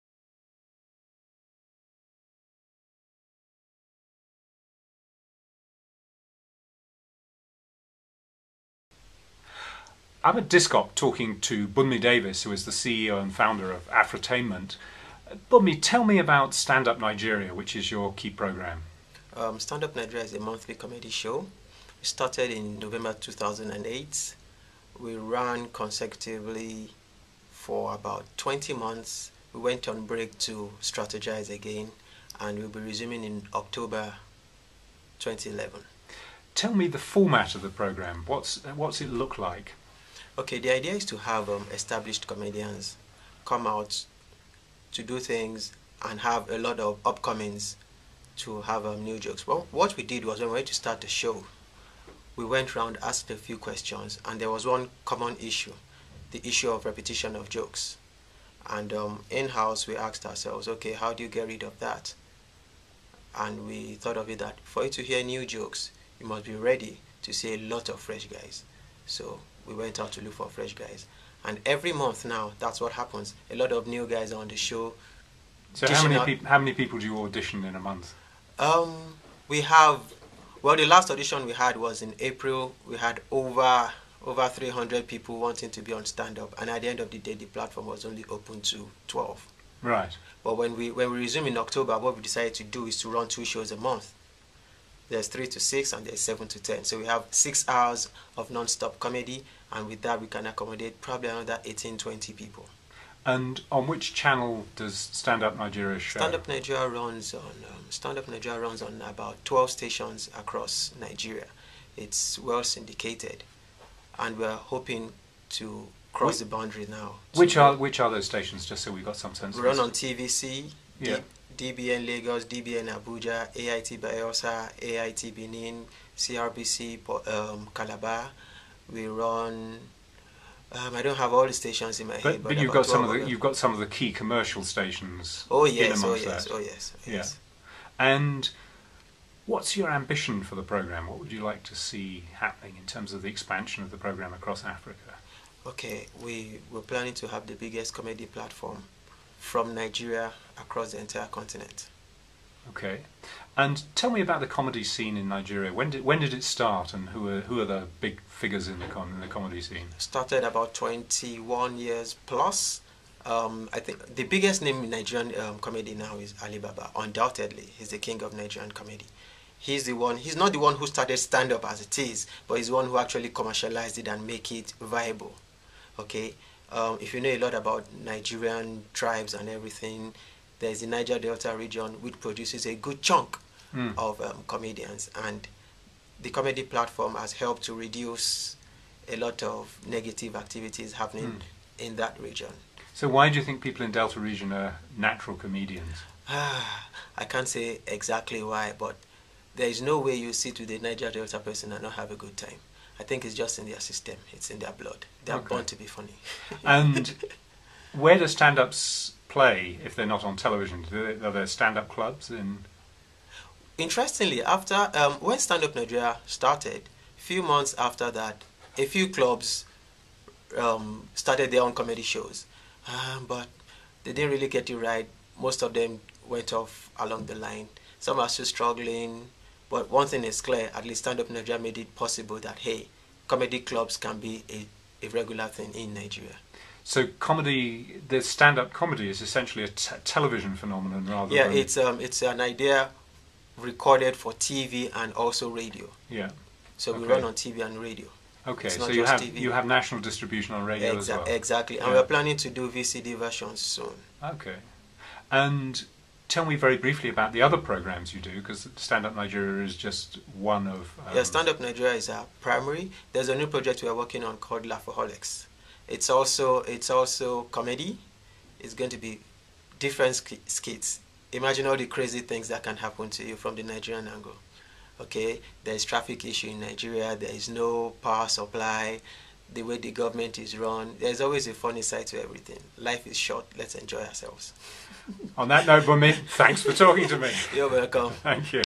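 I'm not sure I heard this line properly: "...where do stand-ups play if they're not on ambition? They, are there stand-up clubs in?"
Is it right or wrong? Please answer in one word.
wrong.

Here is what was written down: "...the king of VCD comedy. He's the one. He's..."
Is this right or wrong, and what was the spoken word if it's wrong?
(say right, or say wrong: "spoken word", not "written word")
wrong: "Nigerian", not "VCD".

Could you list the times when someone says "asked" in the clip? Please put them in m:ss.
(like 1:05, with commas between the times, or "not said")
0:53, 0:59.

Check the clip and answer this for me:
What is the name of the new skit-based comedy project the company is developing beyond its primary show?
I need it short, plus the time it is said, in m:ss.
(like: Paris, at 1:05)
Laughaholics, at 4:24.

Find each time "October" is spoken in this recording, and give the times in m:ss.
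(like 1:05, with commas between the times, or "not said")
0:33, 1:31.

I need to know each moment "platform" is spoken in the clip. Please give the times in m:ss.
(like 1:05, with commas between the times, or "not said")
1:27, 2:28, 3:06.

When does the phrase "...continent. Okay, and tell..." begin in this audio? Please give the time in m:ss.
2:31.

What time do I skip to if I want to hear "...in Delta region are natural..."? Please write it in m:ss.
3:13.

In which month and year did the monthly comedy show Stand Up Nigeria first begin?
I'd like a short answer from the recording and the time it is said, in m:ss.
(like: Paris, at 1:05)
November 2008, at 0:22.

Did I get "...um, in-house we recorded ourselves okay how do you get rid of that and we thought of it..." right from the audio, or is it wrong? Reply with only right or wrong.
wrong.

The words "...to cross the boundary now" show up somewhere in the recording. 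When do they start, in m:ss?
1:55.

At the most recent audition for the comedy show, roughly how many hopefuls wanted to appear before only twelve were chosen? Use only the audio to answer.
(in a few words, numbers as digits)
over 300.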